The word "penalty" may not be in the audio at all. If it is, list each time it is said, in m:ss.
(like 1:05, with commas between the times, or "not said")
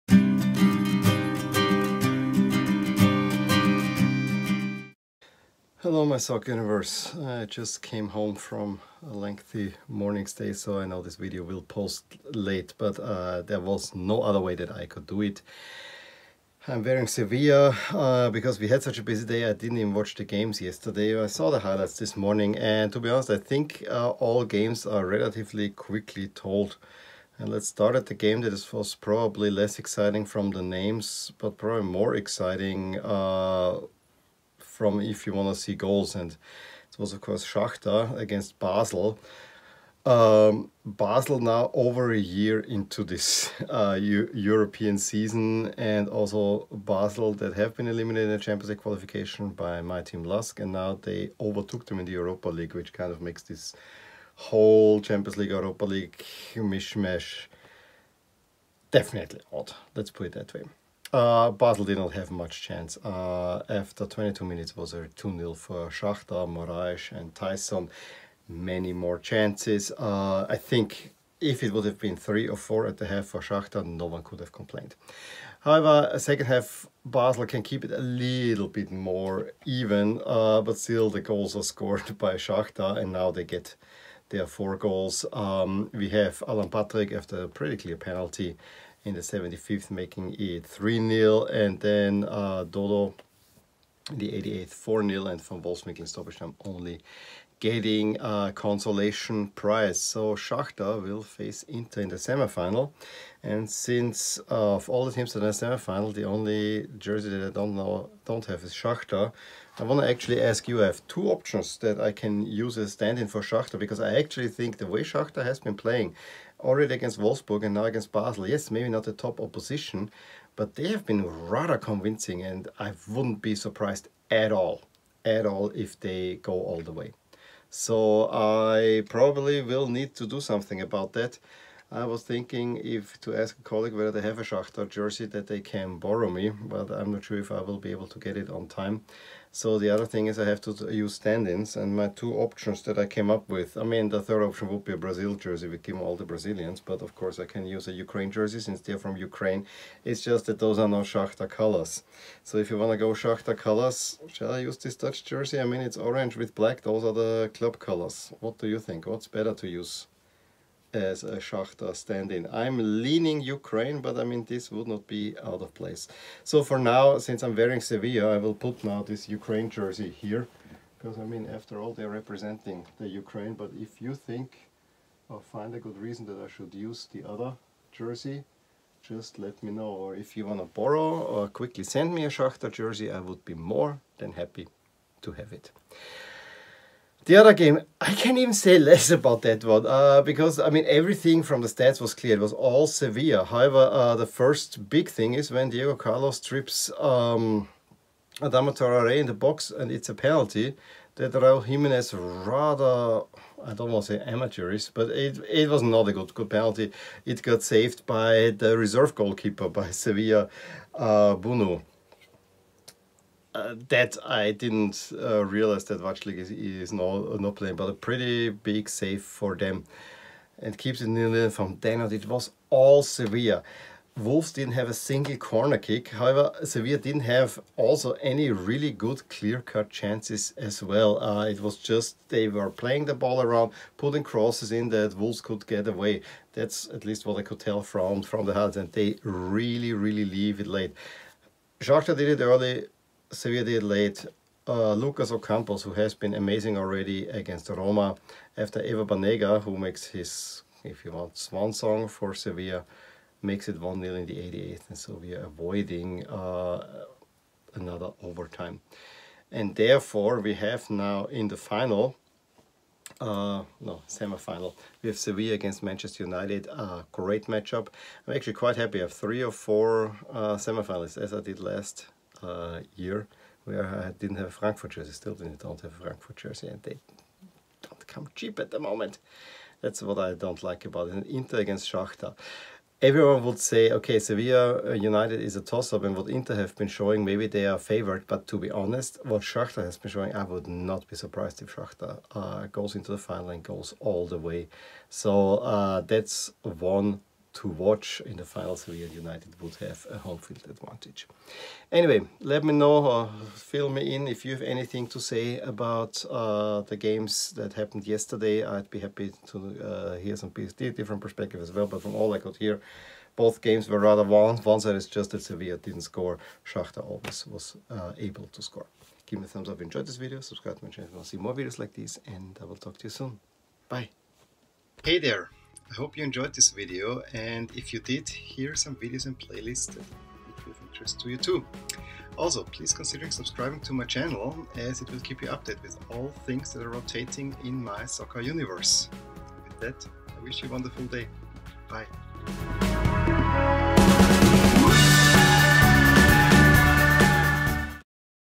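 1:27, 3:20, 3:26.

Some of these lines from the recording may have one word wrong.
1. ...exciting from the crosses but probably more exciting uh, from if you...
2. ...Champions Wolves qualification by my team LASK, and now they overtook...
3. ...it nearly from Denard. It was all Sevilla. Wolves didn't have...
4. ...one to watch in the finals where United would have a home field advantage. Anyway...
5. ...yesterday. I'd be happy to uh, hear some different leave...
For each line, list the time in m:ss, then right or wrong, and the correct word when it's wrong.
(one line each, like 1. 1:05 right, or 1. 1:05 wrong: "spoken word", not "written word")
1. 0:29 wrong: "names", not "crosses"
2. 0:48 wrong: "League", not "Wolves"
3. 3:41 right
4. 4:56 right
5. 5:08 wrong: "perspective", not "leave".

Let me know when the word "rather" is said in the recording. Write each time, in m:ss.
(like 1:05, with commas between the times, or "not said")
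2:01, 3:22, 5:13.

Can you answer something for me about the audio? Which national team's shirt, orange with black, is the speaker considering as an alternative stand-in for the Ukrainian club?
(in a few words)
Dutch.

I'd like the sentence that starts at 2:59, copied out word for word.
Or if you want to borrow or quickly send me a Shakhtar jersey, I would be more than happy to have it.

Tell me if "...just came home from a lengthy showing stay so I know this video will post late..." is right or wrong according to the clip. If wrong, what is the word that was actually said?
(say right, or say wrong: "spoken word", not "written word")
wrong: "morning", not "showing".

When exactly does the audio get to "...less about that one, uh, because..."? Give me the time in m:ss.
3:08.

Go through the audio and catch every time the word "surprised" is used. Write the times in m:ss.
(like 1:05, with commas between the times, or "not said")
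2:03, 4:51.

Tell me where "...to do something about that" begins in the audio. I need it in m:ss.
2:10.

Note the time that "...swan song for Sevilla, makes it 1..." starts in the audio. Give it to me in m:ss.
4:11.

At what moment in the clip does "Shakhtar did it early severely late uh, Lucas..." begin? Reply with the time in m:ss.
4:01.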